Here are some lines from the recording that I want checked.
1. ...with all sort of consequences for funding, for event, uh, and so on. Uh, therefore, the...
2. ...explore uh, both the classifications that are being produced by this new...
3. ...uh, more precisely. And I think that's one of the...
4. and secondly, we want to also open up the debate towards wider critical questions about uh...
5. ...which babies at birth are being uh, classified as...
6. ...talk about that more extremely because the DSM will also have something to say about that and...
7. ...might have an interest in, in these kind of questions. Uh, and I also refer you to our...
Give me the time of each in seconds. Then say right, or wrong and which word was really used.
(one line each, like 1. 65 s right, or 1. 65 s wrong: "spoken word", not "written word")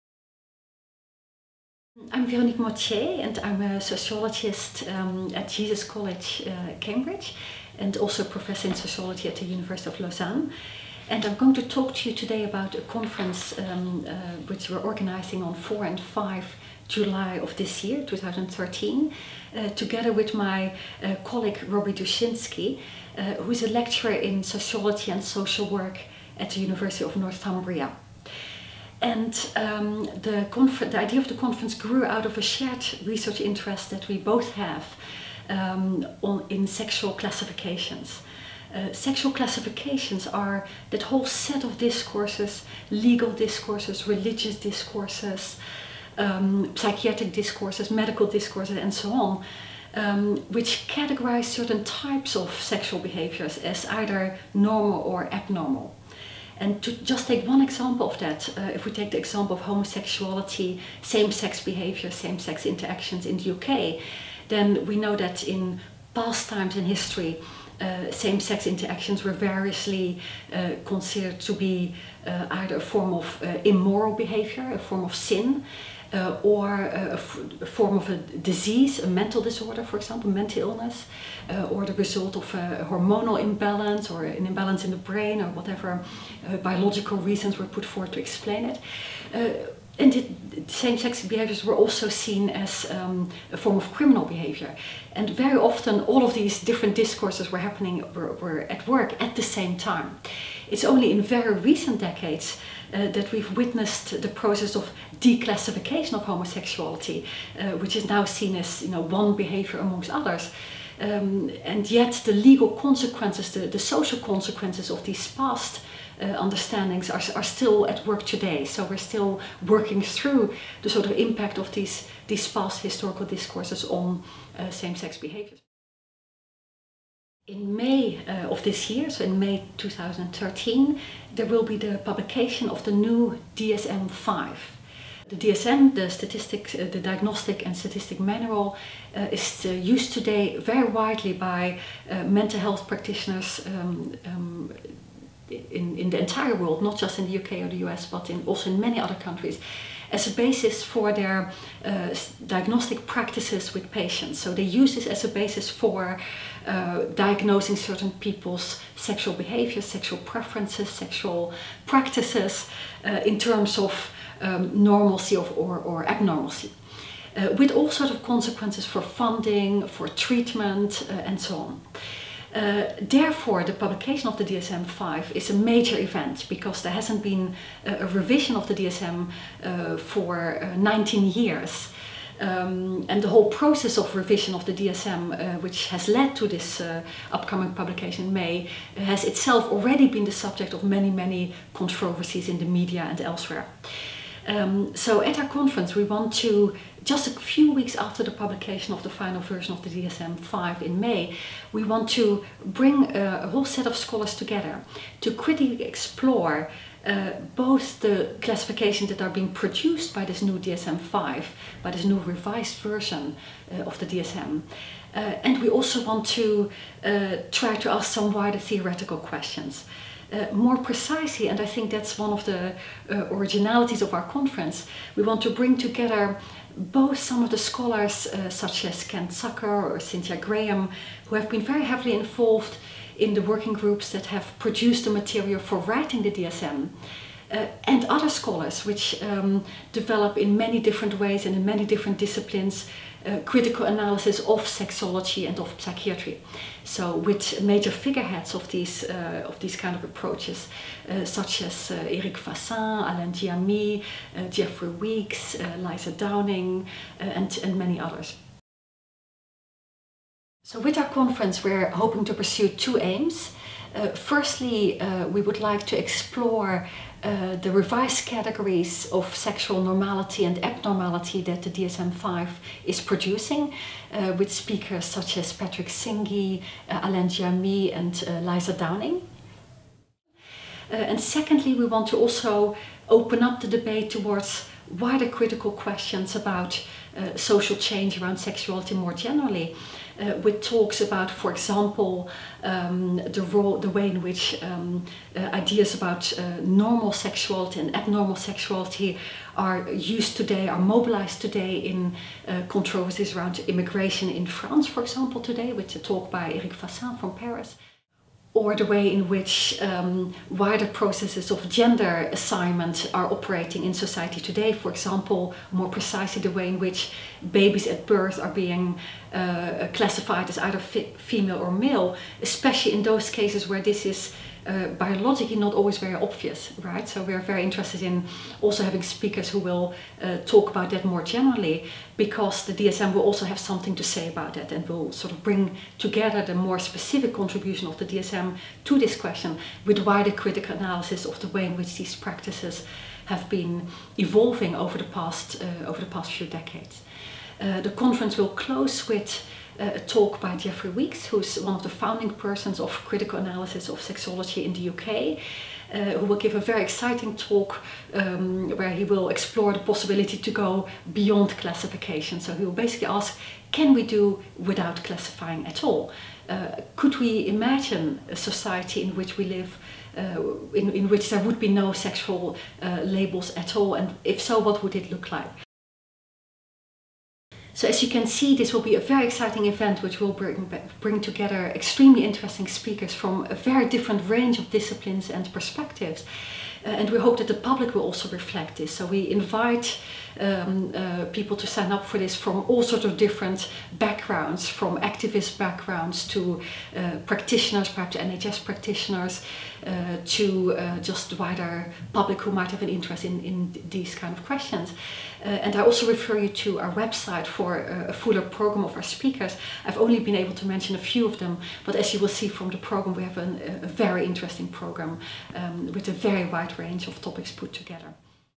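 1. 167 s wrong: "treatment", not "event"
2. 205 s right
3. 220 s right
4. 280 s right
5. 316 s right
6. 330 s wrong: "generally", not "extremely"
7. 402 s right.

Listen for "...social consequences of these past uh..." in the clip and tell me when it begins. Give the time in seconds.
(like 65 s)
113 s.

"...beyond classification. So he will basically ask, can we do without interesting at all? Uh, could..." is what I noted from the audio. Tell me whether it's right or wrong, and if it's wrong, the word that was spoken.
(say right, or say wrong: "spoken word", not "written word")
wrong: "classifying", not "interesting".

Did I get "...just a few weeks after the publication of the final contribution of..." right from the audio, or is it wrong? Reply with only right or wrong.
wrong.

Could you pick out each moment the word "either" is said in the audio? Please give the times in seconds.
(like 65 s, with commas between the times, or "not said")
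53 s, 72 s, 320 s.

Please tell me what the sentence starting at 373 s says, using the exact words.
And if so, what would it look like?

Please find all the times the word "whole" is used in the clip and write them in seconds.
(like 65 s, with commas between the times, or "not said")
41 s, 183 s, 203 s.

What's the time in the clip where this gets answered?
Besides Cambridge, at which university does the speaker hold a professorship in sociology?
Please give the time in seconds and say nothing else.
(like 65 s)
9 s.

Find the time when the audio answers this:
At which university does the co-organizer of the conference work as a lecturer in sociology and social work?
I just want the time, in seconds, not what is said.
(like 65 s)
26 s.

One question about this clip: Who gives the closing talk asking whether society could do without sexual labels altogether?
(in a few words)
Jeffrey Weeks.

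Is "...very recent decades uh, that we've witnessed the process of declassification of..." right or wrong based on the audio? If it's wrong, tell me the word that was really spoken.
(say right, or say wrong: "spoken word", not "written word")
right.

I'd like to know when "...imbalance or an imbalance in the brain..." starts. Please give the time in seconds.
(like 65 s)
83 s.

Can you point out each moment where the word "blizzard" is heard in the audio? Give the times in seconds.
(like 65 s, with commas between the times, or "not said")
not said.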